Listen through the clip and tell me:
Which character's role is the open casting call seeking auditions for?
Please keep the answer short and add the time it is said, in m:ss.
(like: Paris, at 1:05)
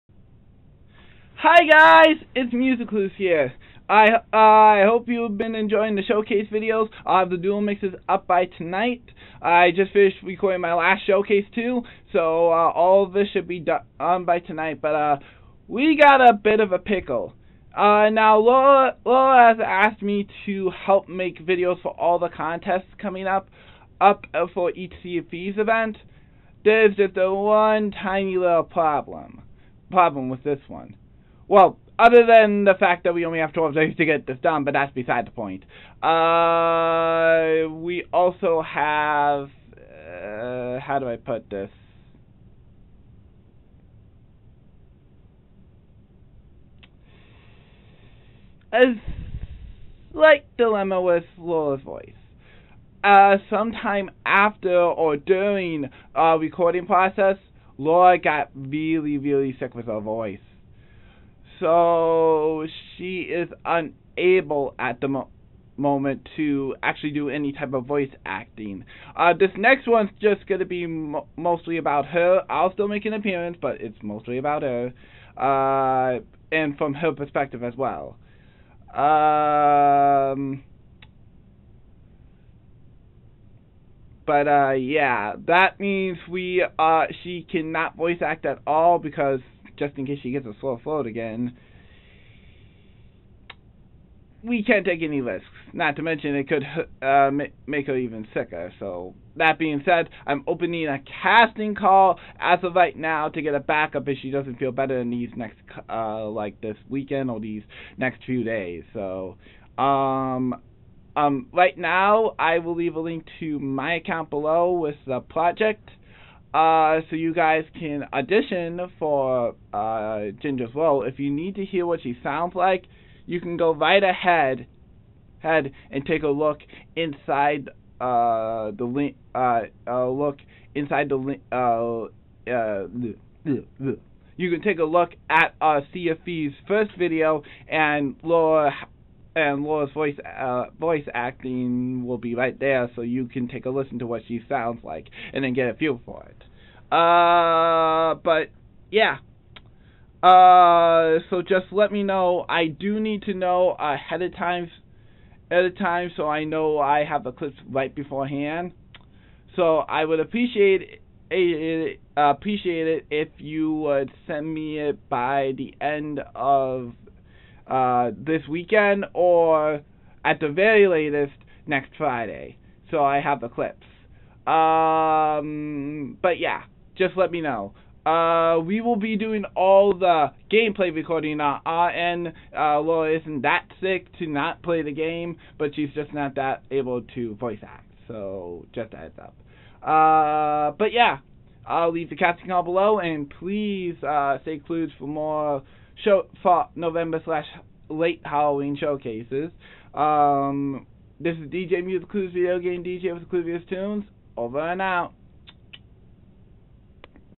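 Ginger, at 2:00.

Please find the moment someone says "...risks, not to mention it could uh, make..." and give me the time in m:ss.
1:35.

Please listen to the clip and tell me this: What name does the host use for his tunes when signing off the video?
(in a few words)
Clues Tunes.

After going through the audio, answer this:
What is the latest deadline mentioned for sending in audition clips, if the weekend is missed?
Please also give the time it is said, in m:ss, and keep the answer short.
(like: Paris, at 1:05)
Next Friday, at 2:51.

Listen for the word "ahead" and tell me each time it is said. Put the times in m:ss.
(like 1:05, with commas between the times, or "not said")
2:04, 2:33.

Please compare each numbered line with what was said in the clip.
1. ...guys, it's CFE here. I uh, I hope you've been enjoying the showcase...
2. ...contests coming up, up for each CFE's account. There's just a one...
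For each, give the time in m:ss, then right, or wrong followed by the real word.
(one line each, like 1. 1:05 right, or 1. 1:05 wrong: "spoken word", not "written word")
1. 0:01 wrong: "MusicClues", not "CFE"
2. 0:22 wrong: "event", not "account".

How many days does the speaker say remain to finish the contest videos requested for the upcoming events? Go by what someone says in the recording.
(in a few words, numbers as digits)
12.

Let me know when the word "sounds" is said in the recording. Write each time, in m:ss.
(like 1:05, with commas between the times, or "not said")
2:02, 2:24.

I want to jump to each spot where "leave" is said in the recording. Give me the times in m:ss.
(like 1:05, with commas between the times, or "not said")
1:52, 3:11.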